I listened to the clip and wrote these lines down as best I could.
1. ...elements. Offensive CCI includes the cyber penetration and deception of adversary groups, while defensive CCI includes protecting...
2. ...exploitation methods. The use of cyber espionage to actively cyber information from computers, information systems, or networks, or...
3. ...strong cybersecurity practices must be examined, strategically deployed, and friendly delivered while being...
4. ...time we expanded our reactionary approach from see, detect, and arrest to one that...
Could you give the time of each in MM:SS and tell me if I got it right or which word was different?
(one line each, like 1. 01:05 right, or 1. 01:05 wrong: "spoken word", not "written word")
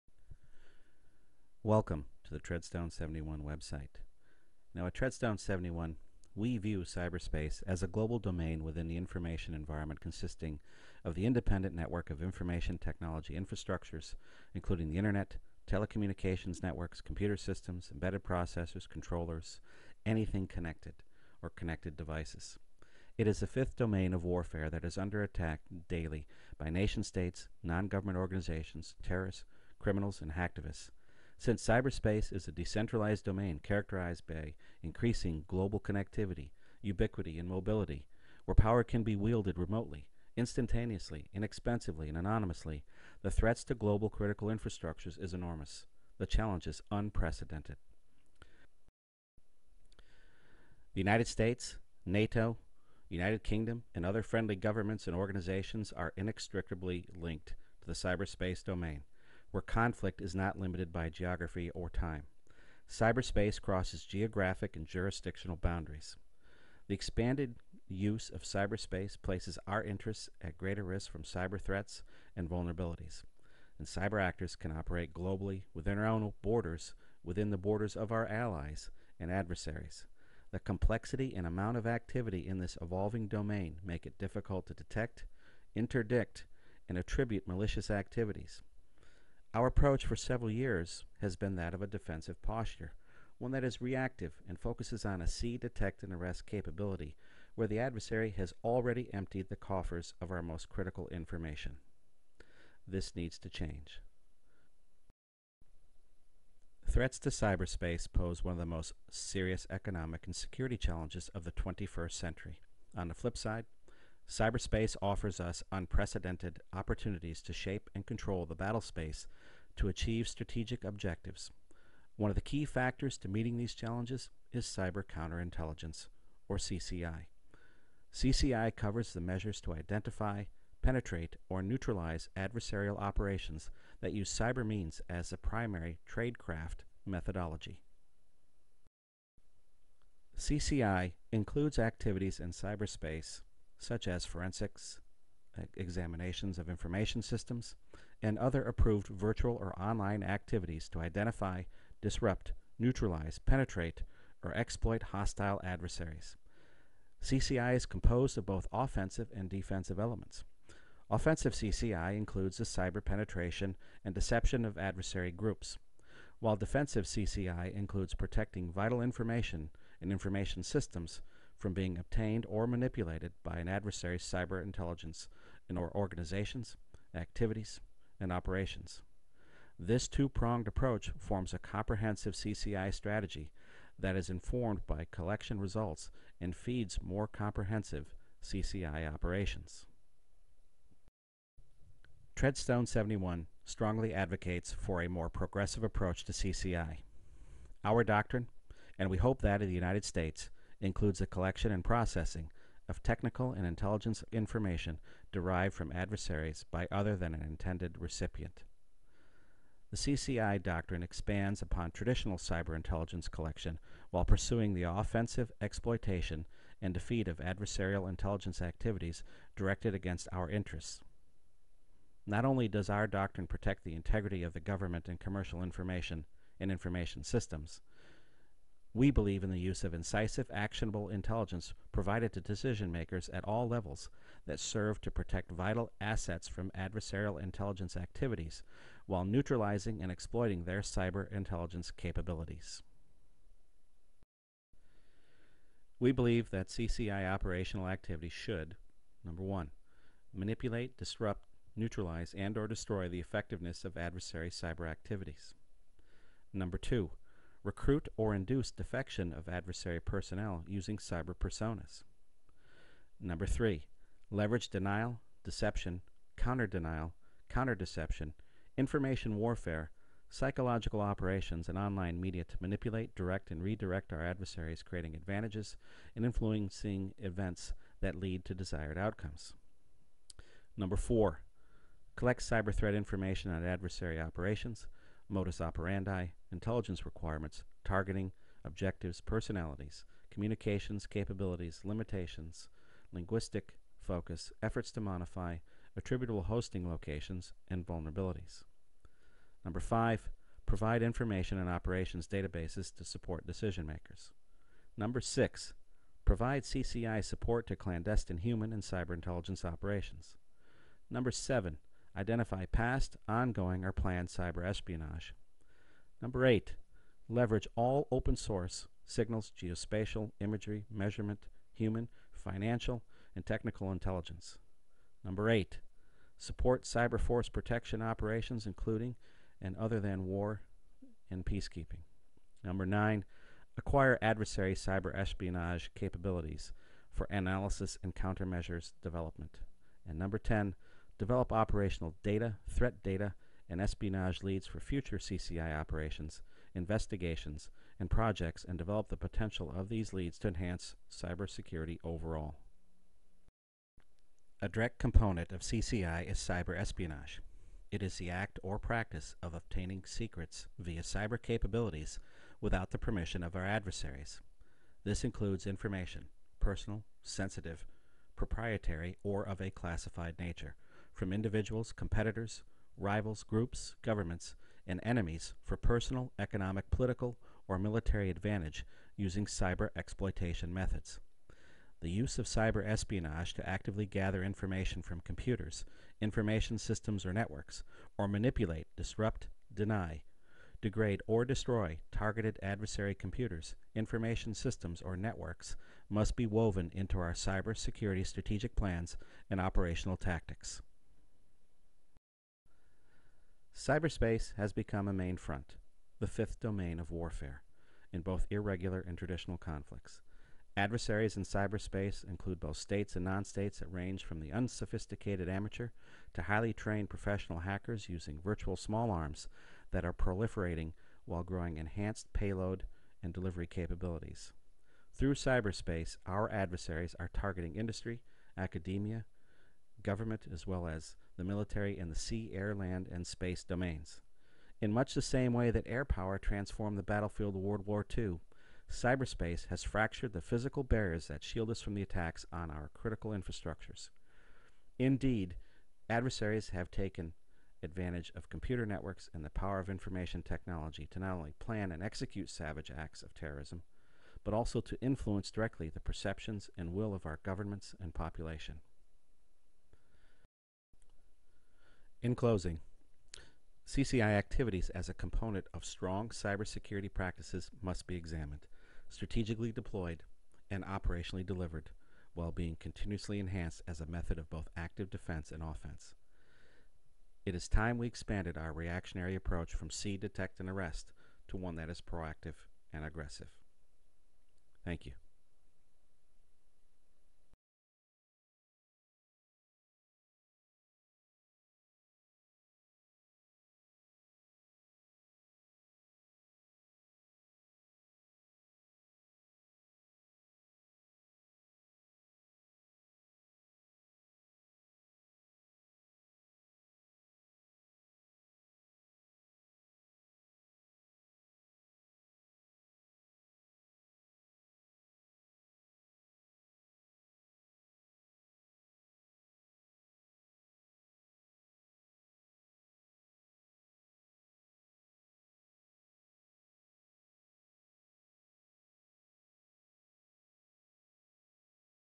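1. 02:39 right
2. 06:19 wrong: "gather", not "cyber"
3. 07:45 wrong: "operationally", not "friendly"
4. 07:57 right.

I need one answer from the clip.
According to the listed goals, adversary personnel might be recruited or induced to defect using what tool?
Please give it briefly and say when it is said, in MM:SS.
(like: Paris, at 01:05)
cyber personas, at 04:20.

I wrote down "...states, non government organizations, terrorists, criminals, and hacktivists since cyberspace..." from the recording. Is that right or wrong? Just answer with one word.
right.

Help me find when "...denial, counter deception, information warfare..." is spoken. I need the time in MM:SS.
04:26.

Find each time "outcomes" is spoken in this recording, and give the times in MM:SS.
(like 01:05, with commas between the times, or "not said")
04:38.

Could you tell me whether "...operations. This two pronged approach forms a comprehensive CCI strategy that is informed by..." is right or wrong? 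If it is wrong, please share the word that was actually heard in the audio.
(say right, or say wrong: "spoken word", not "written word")
right.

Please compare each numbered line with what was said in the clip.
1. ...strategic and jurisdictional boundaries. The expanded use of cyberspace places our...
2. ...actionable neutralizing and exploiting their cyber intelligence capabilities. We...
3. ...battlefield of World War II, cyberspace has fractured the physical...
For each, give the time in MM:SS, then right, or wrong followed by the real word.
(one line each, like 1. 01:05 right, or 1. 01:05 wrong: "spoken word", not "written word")
1. 01:04 wrong: "geographic", not "strategic"
2. 03:59 wrong: "while", not "actionable"
3. 07:17 right.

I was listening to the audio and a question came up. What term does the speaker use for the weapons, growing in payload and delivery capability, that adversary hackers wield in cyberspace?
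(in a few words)
virtual small arms.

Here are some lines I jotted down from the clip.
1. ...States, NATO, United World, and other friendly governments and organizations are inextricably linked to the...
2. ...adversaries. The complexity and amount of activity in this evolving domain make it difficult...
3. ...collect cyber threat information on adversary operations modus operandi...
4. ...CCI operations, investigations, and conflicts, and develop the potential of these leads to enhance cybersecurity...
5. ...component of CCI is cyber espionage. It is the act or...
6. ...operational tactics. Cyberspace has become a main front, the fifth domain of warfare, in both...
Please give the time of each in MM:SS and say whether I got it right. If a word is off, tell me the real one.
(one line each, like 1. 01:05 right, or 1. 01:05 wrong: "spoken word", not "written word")
1. 00:51 wrong: "Kingdom", not "World"
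2. 01:19 right
3. 04:42 right
4. 05:45 wrong: "projects", not "conflicts"
5. 05:54 right
6. 06:39 right.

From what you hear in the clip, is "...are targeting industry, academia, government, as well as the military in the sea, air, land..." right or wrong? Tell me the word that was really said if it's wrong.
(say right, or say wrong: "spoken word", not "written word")
right.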